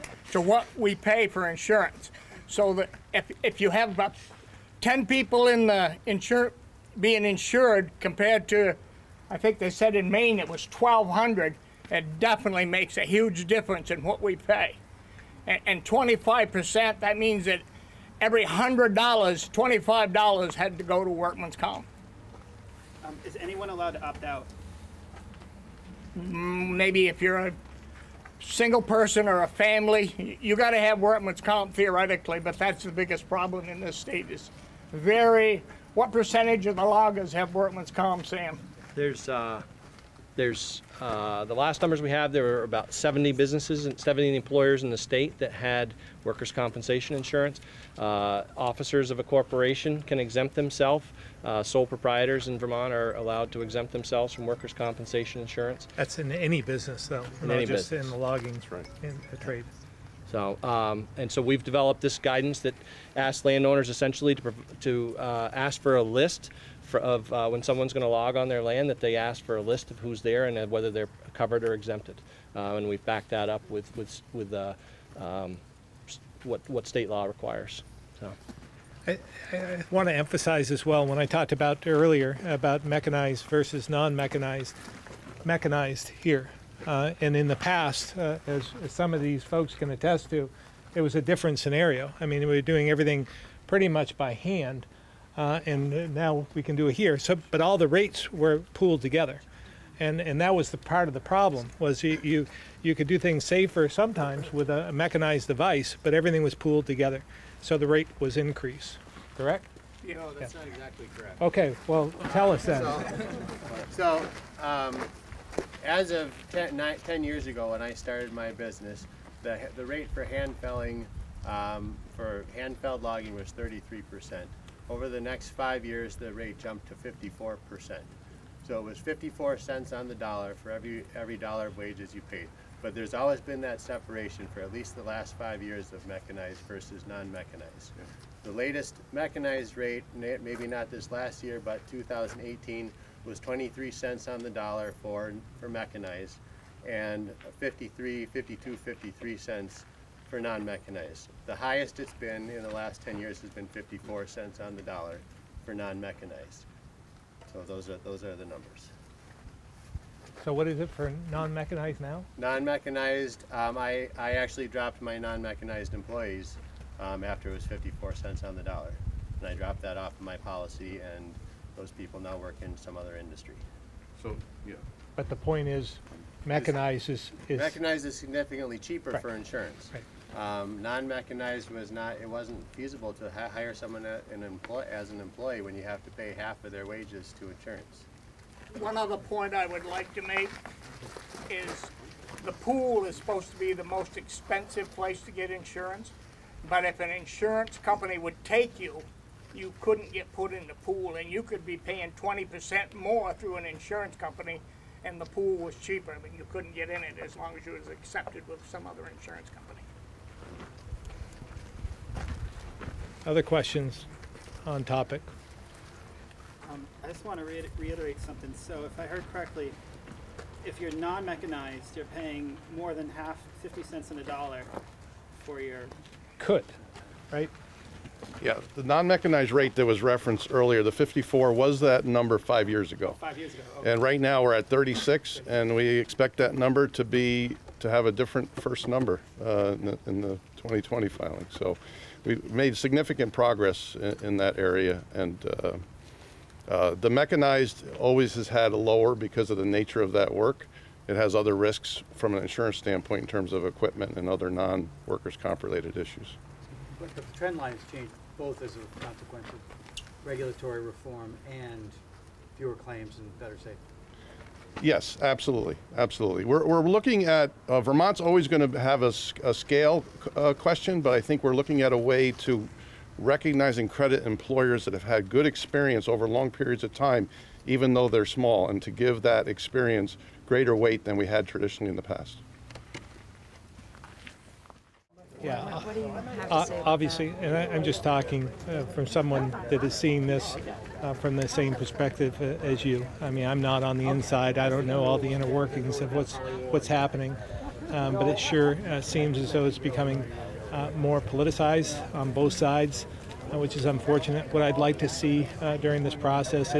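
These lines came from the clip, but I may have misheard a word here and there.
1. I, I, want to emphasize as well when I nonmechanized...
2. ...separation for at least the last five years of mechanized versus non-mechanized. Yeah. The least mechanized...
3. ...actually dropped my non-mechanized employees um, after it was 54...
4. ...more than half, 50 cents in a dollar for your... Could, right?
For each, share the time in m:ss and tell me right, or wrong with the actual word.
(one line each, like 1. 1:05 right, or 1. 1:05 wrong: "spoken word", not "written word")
1. 1:19 wrong: "talked", not "nonmechanized"
2. 2:13 wrong: "latest", not "least"
3. 2:44 right
4. 3:42 right.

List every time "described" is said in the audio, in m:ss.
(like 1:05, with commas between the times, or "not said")
not said.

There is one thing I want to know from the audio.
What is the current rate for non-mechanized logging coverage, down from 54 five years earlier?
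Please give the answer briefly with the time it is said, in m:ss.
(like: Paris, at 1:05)
36, at 3:54.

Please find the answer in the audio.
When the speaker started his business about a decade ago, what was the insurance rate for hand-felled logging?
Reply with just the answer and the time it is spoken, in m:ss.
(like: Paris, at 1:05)
33%, at 2:03.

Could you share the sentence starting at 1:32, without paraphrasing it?
I mean, we were doing everything pretty much by hand, uh, and now we can do it here.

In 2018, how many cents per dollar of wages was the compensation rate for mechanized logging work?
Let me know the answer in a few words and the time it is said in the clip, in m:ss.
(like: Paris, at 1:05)
23 cents, at 2:23.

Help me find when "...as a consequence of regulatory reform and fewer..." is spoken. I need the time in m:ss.
4:18.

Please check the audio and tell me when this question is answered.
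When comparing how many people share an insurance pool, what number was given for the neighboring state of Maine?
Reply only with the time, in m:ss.
0:10.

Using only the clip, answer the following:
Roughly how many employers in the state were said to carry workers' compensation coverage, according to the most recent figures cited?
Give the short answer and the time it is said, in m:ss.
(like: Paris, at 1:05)
70, at 0:42.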